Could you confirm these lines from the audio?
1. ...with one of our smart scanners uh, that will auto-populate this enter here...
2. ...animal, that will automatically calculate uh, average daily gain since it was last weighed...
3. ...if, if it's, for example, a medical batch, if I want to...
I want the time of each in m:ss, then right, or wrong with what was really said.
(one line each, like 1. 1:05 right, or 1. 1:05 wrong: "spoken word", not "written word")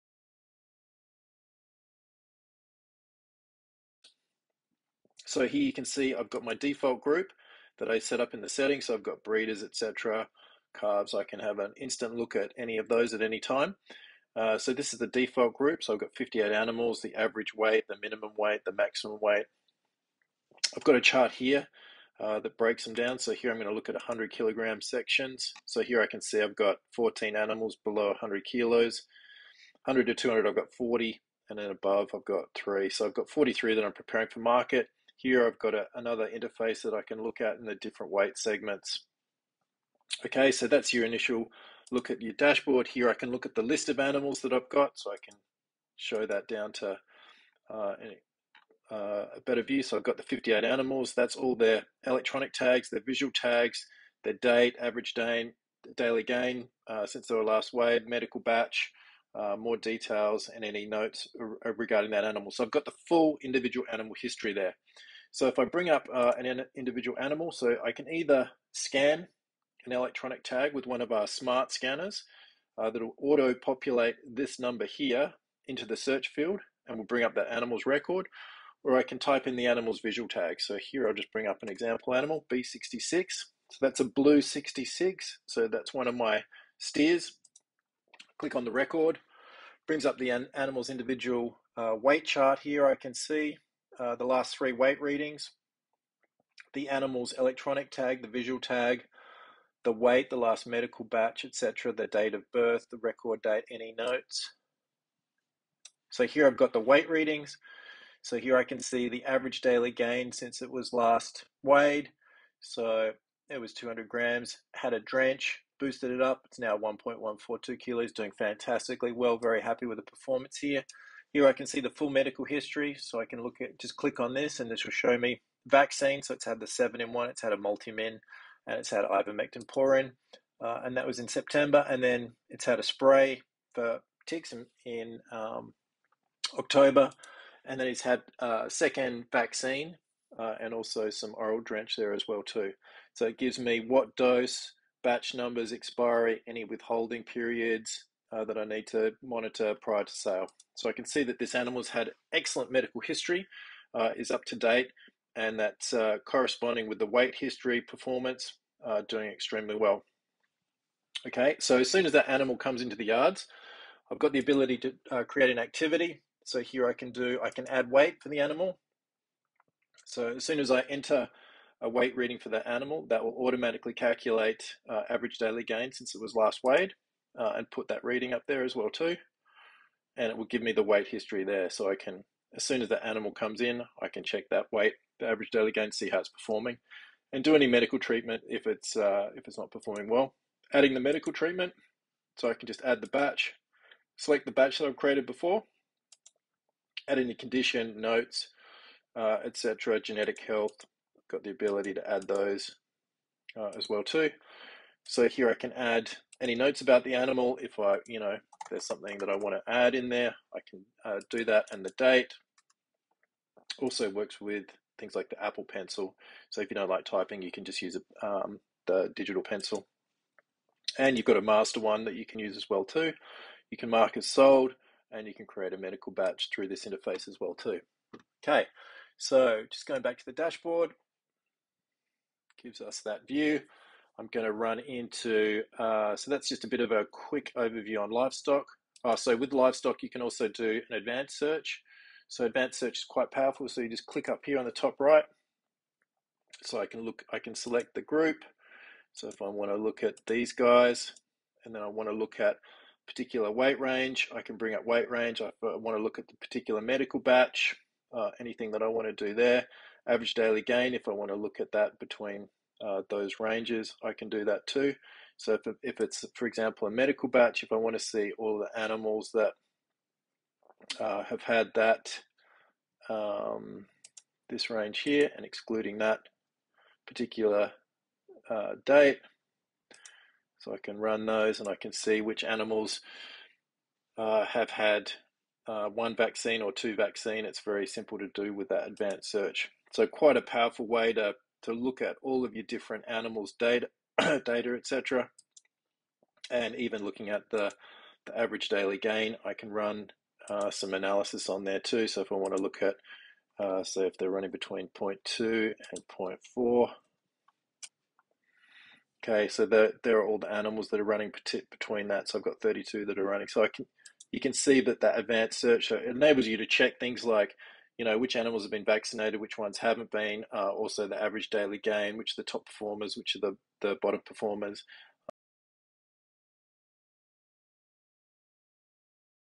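1. 1:10 wrong: "number", not "enter"
2. 2:52 right
3. 4:25 right.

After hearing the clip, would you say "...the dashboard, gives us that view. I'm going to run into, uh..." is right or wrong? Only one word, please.
right.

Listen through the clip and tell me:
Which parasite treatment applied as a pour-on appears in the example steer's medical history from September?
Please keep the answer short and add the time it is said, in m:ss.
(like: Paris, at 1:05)
Ivermectin, at 2:09.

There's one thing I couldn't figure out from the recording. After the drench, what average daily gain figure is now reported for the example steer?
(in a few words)
1.142 kilos.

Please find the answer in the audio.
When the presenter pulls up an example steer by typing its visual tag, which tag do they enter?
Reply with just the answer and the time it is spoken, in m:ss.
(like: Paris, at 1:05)
B66, at 1:22.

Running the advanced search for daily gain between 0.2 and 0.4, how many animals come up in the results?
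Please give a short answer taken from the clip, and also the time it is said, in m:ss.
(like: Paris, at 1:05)
32, at 5:12.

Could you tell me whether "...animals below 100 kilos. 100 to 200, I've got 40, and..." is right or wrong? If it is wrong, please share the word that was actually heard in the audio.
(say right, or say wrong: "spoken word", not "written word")
right.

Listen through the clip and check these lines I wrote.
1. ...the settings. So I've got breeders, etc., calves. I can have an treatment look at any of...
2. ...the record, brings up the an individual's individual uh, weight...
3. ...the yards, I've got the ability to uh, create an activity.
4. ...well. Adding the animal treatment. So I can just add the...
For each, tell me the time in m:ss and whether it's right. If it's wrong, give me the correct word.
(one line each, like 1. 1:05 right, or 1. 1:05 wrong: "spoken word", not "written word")
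1. 0:08 wrong: "instant", not "treatment"
2. 1:28 wrong: "animal", not "individual"
3. 2:42 right
4. 3:10 wrong: "medical", not "animal".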